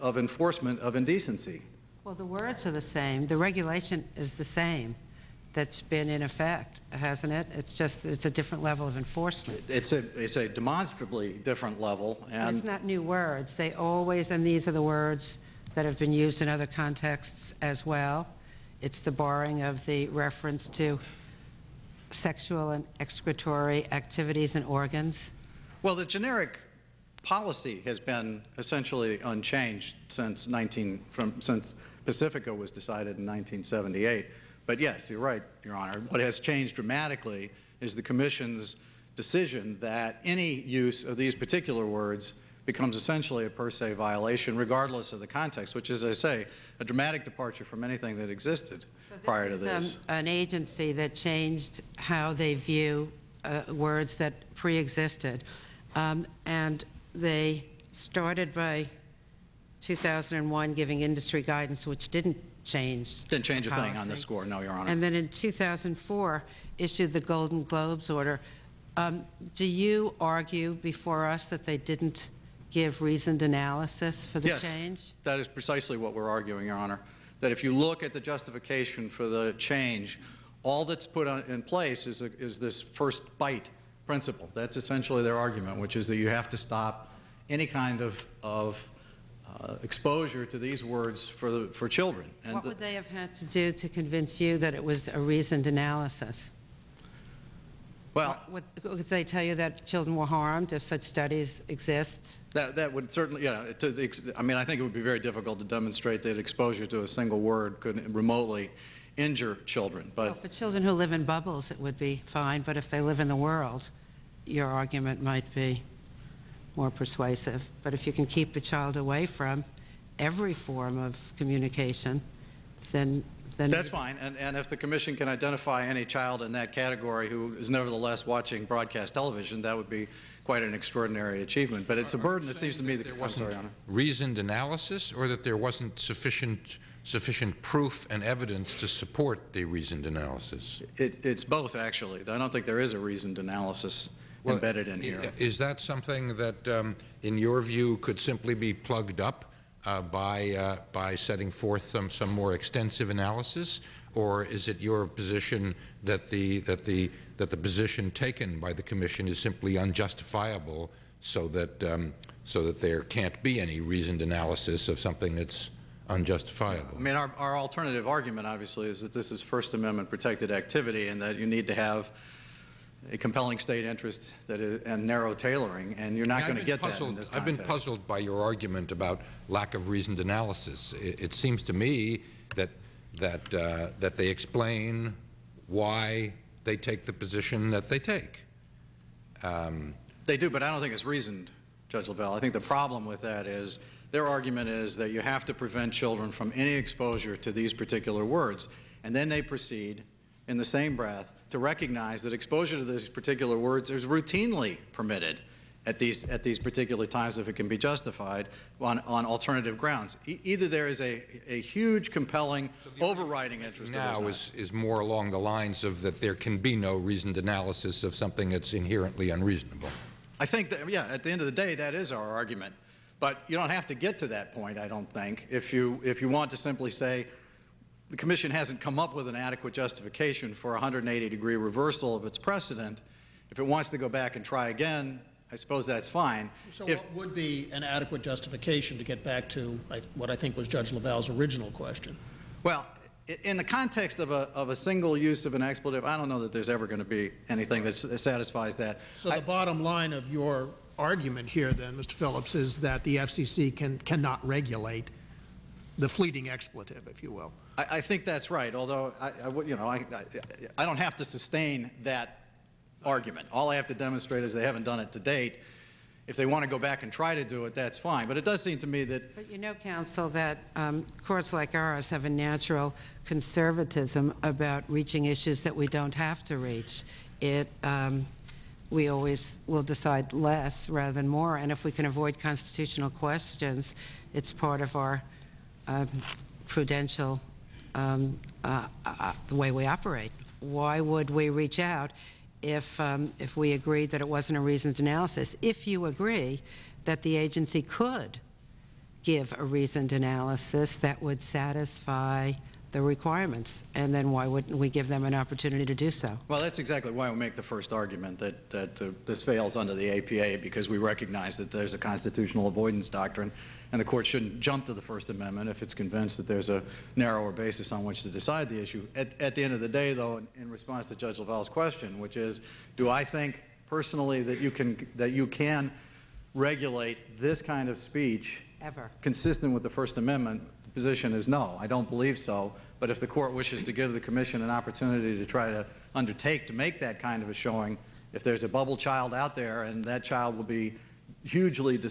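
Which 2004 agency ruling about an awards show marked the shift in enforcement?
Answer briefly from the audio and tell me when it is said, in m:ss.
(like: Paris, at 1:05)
Golden Globes order, at 1:07.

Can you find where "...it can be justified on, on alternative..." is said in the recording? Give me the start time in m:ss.
3:27.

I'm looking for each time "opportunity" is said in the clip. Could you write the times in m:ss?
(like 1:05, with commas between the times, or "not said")
5:05, 5:34.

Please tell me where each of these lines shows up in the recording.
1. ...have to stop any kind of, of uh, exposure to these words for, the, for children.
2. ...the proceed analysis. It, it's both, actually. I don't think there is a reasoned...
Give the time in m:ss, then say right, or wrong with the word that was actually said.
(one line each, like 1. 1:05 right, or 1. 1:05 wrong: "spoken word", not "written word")
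1. 1:26 right
2. 2:19 wrong: "reasoned", not "proceed".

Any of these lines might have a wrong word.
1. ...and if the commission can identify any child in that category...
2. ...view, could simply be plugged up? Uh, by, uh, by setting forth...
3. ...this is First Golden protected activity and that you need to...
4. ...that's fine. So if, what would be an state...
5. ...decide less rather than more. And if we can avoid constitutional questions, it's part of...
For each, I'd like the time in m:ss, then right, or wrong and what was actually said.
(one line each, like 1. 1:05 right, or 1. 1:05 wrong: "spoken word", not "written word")
1. 2:04 right
2. 2:27 right
3. 2:49 wrong: "Amendment", not "Golden"
4. 3:55 wrong: "adequate", not "state"
5. 4:39 right.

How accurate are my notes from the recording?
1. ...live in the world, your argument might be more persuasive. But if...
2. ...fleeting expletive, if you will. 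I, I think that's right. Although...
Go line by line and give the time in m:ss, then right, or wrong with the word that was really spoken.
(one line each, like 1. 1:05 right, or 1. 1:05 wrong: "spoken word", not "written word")
1. 1:52 right
2. 4:16 right.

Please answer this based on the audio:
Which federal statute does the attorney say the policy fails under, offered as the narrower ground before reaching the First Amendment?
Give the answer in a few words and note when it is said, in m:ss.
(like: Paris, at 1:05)
APA, at 5:10.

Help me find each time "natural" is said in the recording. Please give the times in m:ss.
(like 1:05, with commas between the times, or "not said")
4:32.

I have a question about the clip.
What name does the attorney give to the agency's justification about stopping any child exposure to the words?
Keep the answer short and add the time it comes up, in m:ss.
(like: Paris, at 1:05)
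first bite principle, at 1:22.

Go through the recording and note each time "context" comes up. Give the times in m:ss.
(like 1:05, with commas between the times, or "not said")
0:16, 0:45, 4:03.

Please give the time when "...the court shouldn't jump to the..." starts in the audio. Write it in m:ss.
5:13.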